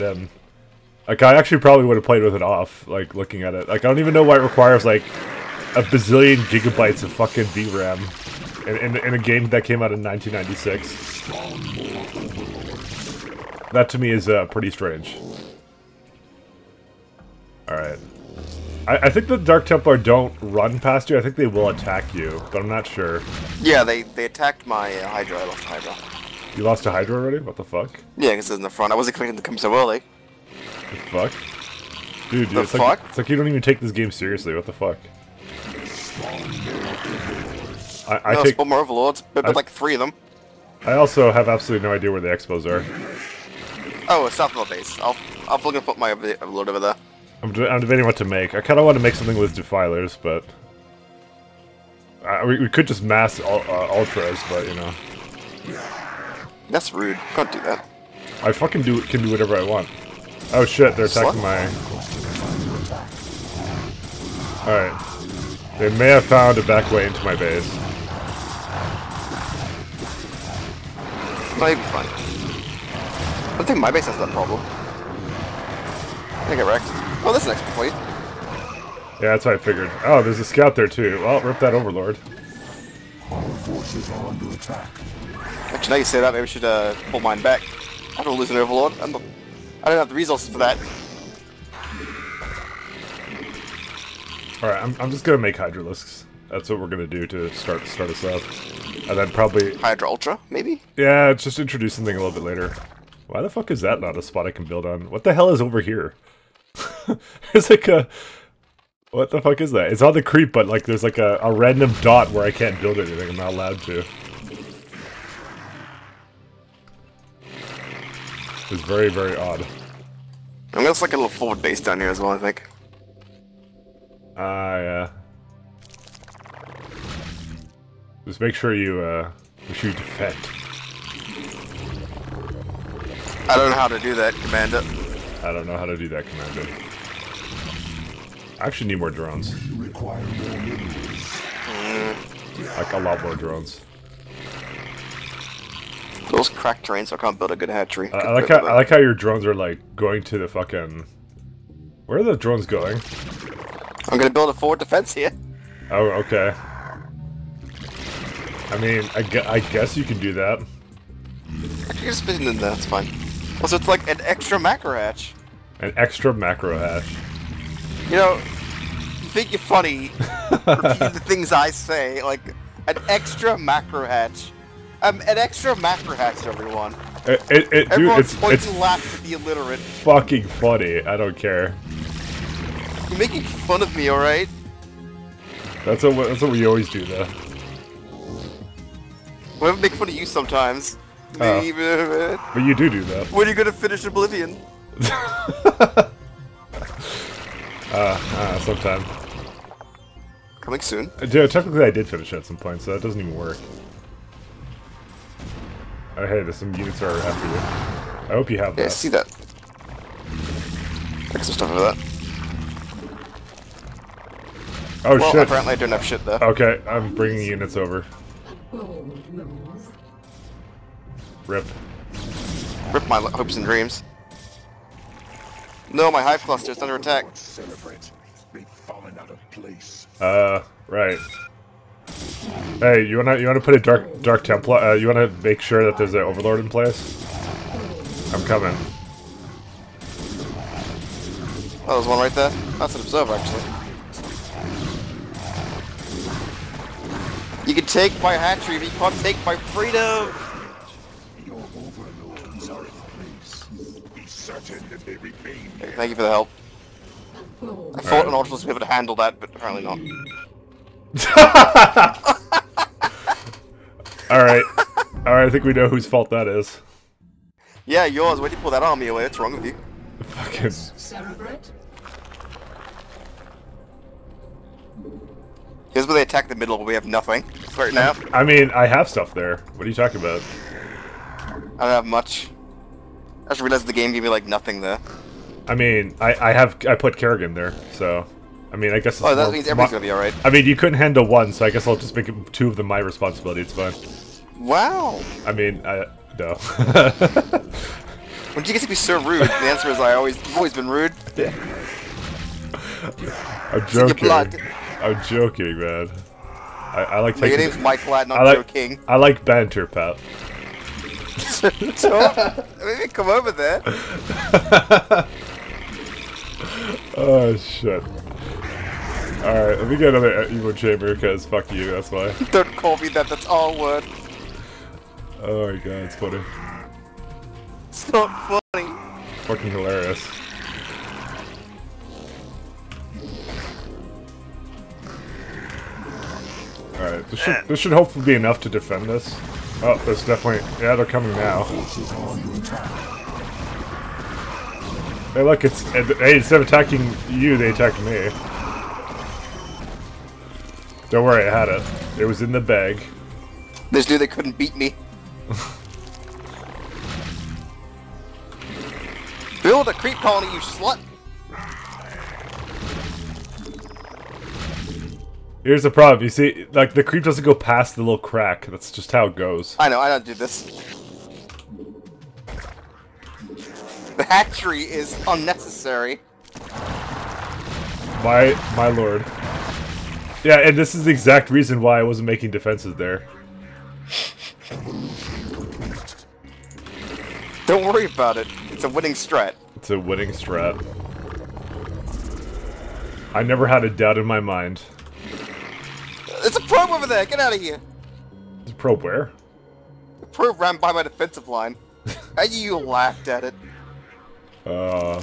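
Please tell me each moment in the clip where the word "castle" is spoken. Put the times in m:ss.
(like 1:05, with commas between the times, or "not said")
not said.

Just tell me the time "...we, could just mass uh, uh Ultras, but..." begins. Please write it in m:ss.
0:52.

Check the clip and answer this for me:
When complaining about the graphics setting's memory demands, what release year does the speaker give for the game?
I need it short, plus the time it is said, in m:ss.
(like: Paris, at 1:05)
1996, at 0:10.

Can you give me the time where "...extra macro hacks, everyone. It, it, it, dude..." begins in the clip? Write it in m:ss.
2:55.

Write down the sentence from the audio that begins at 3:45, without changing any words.
No, my hive cluster is under attack.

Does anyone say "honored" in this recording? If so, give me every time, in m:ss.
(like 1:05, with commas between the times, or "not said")
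not said.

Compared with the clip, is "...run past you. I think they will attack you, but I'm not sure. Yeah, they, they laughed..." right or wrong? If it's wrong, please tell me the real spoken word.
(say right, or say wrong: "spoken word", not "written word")
wrong: "attacked", not "laughed".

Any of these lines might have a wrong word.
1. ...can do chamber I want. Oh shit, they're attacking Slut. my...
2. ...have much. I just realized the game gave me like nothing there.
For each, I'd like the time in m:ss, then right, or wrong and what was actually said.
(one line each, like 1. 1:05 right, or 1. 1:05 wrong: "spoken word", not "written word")
1. 0:59 wrong: "whatever", not "chamber"
2. 4:41 right.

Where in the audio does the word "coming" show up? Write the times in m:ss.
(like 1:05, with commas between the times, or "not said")
3:20, 3:58, 5:41.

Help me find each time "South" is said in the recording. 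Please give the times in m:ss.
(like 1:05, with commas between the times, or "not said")
0:44.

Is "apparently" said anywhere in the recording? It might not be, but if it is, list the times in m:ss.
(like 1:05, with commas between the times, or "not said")
3:35, 4:19.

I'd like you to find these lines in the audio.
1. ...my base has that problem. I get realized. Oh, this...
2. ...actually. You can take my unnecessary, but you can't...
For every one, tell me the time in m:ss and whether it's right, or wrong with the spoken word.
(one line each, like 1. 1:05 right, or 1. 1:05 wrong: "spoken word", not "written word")
1. 1:13 wrong: "wrecked", not "realized"
2. 4:03 wrong: "hatchery", not "unnecessary".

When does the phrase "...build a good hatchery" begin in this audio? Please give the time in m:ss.
2:27.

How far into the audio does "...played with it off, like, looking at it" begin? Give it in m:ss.
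0:02.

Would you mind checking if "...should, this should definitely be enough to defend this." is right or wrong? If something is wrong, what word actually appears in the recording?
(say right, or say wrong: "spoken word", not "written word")
wrong: "hopefully", not "definitely".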